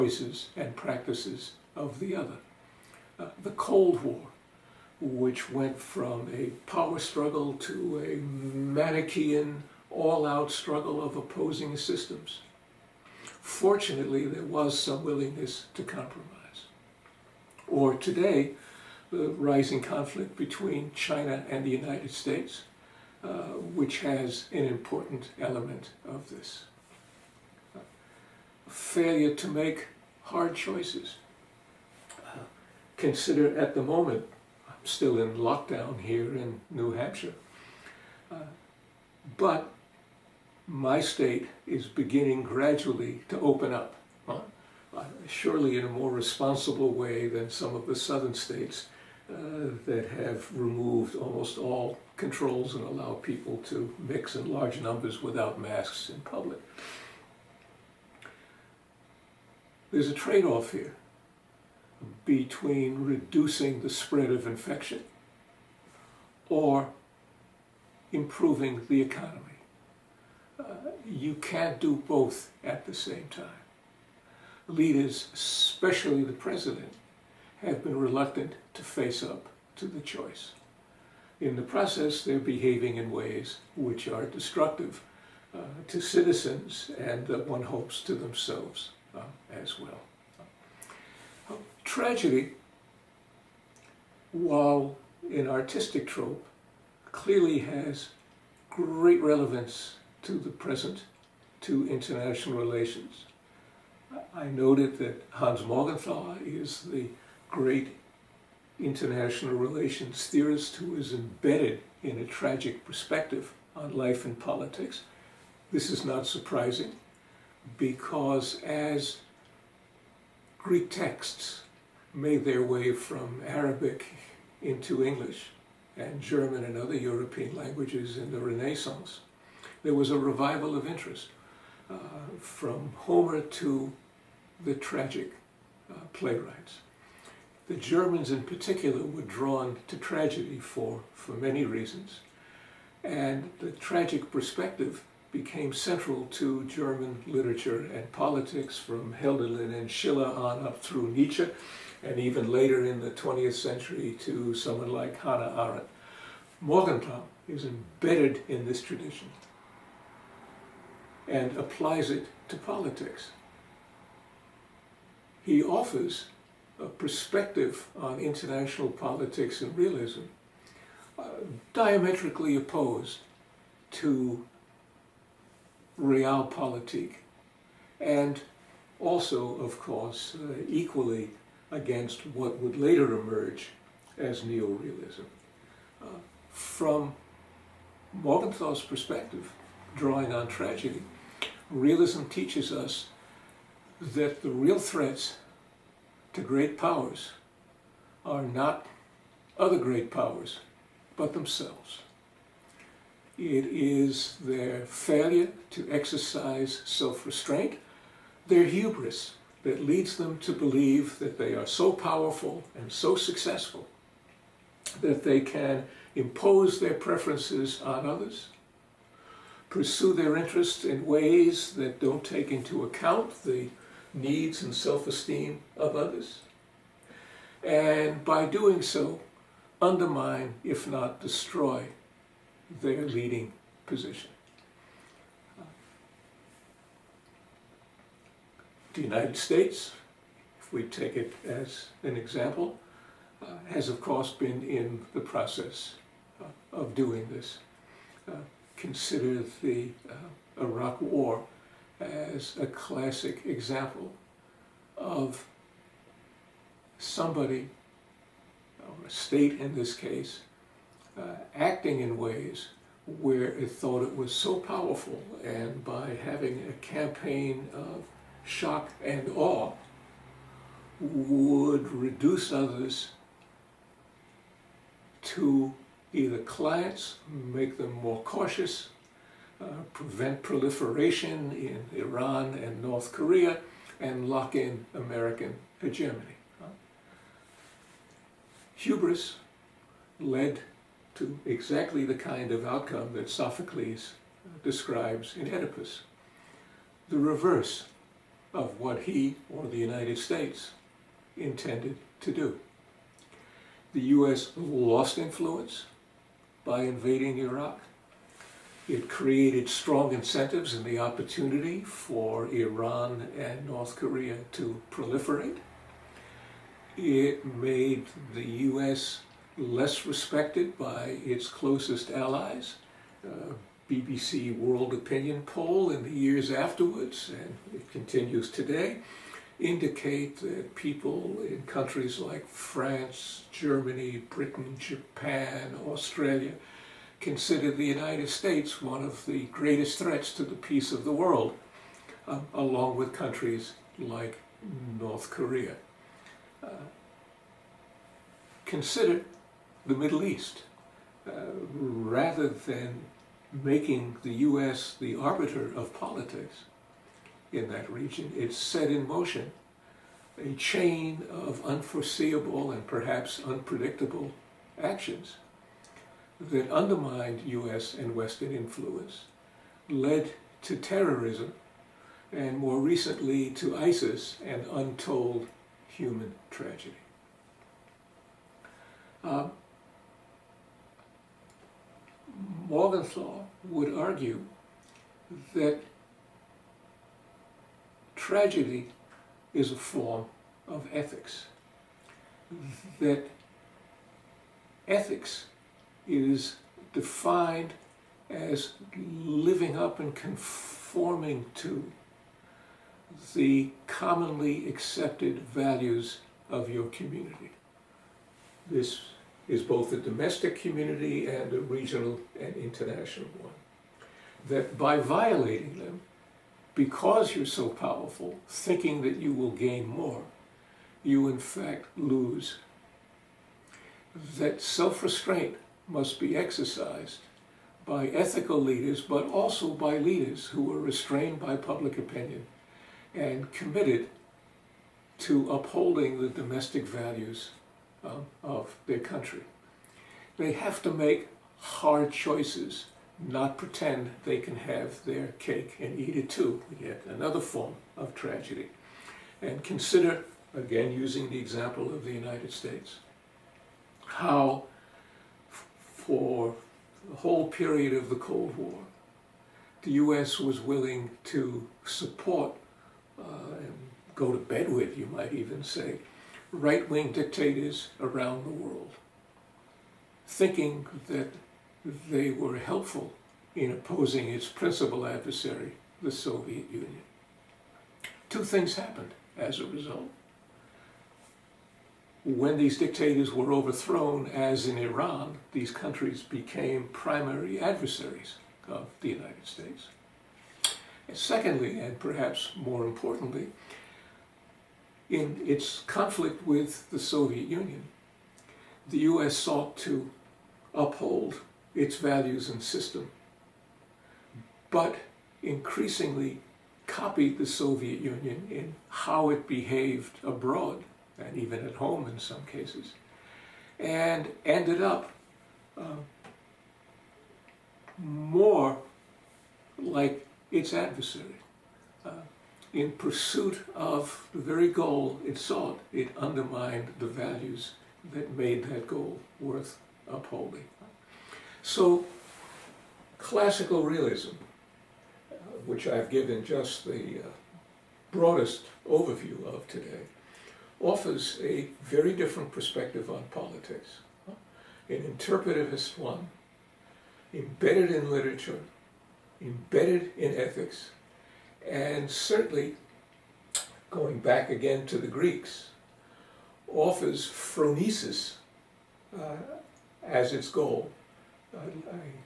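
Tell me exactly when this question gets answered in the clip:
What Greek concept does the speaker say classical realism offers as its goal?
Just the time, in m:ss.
9:17.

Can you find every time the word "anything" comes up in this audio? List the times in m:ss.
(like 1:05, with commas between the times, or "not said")
not said.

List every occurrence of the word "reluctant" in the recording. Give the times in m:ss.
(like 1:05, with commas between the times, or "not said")
1:17.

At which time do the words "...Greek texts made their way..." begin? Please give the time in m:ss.
2:00.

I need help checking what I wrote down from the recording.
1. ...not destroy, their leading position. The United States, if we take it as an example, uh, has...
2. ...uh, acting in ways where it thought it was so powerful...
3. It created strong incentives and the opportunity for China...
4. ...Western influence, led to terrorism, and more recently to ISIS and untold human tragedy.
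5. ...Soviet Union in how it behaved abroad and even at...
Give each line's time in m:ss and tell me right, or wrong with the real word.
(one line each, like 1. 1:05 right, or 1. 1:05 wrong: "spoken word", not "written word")
1. 3:50 right
2. 4:21 right
3. 5:08 wrong: "Iran", not "China"
4. 6:08 right
5. 8:27 right.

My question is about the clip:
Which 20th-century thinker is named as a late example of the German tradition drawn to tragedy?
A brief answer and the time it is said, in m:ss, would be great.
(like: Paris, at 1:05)
Hannah Arendt, at 2:35.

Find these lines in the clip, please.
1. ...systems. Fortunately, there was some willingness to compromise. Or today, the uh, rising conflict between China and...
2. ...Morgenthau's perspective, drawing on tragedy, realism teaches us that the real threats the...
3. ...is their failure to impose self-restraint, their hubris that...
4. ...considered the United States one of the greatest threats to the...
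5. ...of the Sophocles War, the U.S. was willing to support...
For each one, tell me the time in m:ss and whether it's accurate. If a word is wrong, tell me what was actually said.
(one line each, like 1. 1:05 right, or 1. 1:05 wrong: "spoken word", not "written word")
1. 0:11 right
2. 3:08 right
3. 3:23 wrong: "exercise", not "impose"
4. 5:37 right
5. 7:37 wrong: "Cold", not "Sophocles".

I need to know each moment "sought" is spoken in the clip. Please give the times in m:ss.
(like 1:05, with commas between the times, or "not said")
8:19, 8:45.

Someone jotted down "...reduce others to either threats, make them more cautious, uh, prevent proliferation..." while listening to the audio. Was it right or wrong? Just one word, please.
wrong.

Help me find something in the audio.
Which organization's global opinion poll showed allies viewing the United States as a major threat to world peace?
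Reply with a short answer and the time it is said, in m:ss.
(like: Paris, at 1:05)
BBC, at 5:23.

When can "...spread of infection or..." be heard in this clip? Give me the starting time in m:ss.
1:03.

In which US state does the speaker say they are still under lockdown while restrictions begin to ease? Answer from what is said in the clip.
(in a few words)
New Hampshire.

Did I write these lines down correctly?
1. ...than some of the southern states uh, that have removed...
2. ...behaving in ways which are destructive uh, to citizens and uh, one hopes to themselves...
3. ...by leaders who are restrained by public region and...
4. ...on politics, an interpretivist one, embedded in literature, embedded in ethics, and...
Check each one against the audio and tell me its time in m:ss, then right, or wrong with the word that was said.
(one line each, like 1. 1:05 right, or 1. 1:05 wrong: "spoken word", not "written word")
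1. 0:47 right
2. 1:22 right
3. 7:09 wrong: "opinion", not "region"
4. 9:03 right.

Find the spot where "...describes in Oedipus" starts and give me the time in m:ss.
4:54.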